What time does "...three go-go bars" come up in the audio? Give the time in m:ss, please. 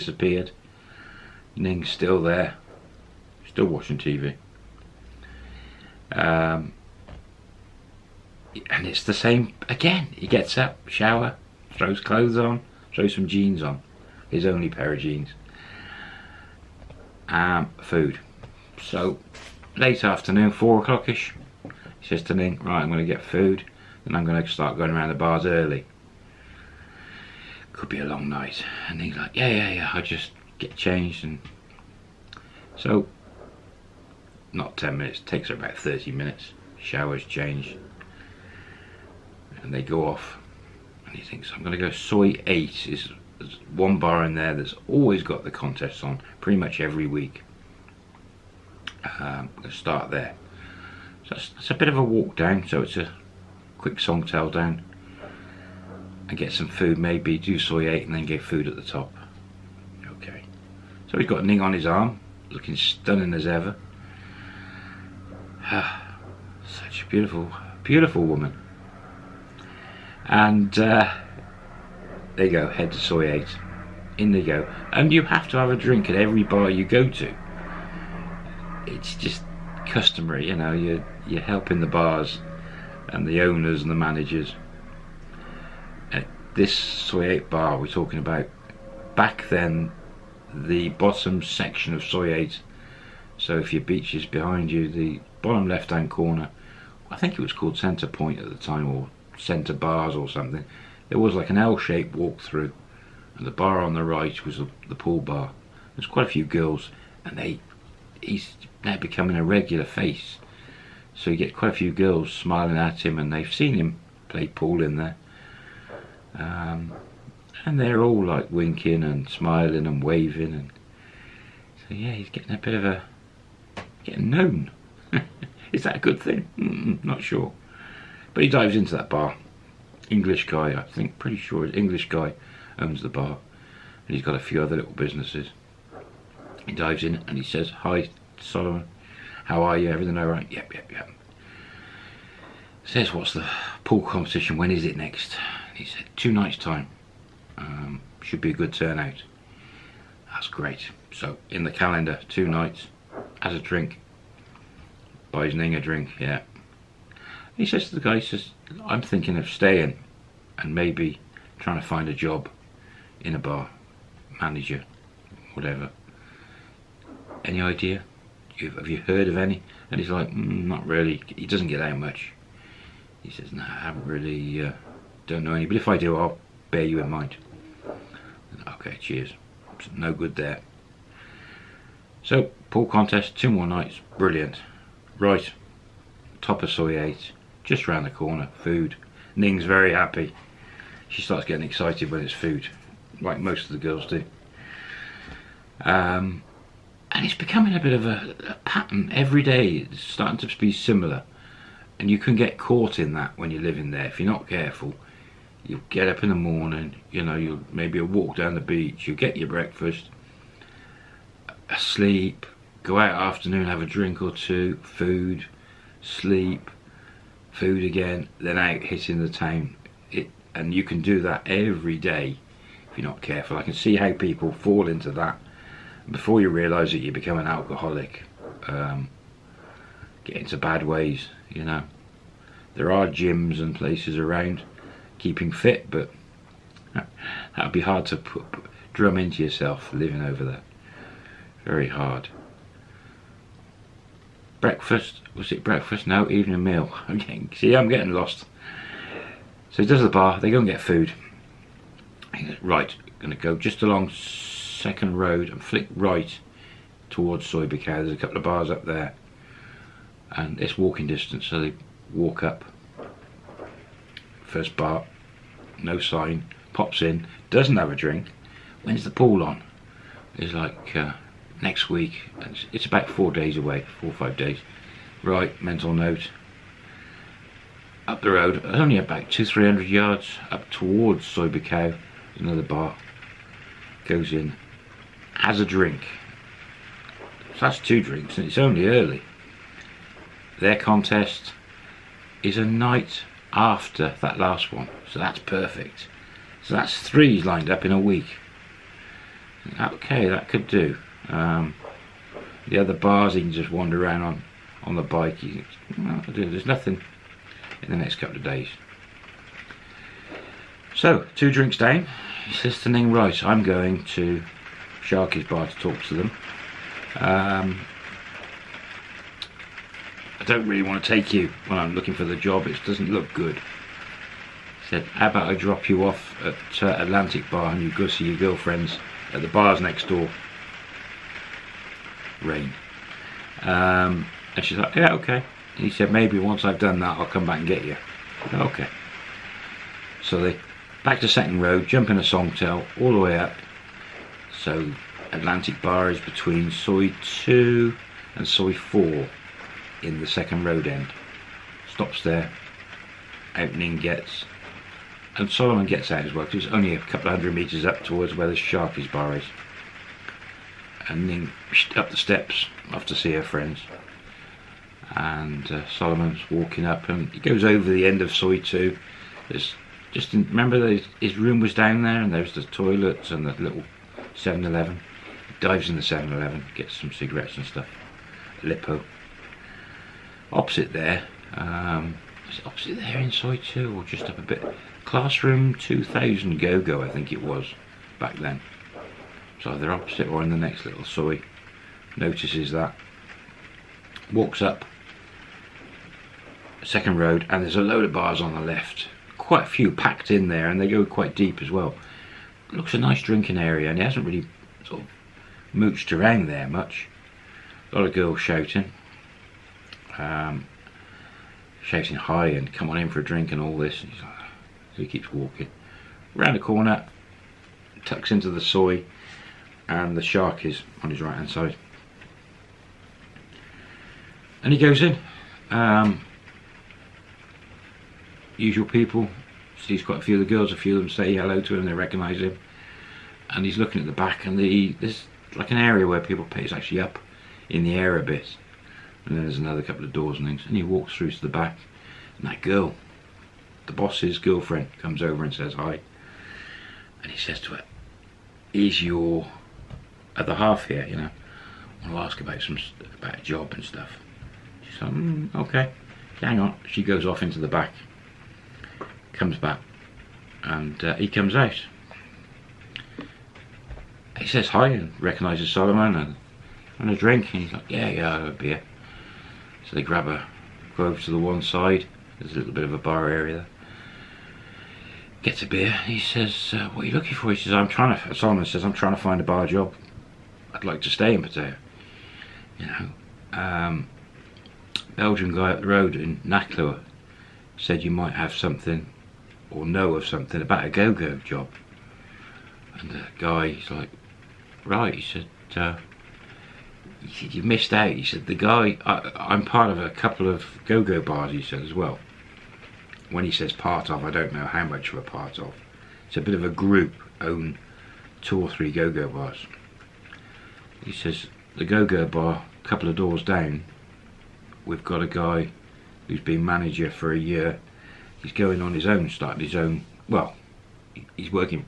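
8:28.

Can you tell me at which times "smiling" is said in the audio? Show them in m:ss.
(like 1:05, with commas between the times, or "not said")
1:52, 1:59.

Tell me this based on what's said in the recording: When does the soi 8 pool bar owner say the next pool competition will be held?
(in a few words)
Two nights' time.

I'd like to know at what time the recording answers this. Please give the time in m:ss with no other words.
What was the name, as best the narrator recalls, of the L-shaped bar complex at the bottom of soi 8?
1:37.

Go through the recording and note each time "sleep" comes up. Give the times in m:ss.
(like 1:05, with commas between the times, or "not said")
3:31, 3:36.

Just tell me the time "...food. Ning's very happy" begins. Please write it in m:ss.
3:08.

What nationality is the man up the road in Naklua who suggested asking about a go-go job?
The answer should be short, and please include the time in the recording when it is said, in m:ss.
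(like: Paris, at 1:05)
Belgian, at 8:05.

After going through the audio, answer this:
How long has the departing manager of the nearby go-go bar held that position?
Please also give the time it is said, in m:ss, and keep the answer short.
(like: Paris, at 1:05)
A year, at 8:37.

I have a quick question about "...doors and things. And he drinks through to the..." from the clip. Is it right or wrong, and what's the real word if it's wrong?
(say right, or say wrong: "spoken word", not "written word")
wrong: "walks", not "drinks".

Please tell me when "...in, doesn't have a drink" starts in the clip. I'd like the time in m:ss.
4:27.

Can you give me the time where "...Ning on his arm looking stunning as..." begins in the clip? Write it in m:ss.
1:01.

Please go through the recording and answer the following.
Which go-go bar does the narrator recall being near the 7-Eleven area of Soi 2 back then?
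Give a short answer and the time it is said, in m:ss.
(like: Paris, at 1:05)
Classroom 2000, at 6:25.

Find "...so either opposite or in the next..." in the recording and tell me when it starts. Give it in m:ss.
6:29.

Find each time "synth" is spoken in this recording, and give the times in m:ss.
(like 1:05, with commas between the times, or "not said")
not said.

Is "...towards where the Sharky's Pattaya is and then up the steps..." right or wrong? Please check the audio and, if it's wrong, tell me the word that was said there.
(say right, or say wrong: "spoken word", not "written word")
wrong: "Bar", not "Pattaya".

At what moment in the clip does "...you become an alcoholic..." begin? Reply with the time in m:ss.
3:47.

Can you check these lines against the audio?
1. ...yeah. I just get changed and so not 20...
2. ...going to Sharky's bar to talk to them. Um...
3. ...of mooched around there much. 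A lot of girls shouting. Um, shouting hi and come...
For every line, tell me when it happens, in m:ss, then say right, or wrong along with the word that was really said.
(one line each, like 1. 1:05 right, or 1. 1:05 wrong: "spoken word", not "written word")
1. 0:29 wrong: "10", not "20"
2. 5:13 right
3. 6:45 right.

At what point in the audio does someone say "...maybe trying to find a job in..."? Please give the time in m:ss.
2:40.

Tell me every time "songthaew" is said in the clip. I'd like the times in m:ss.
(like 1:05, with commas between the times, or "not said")
0:53, 5:42.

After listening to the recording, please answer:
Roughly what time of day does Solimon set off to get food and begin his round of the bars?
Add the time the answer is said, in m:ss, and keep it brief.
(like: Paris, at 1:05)
4 o'clock, at 0:20.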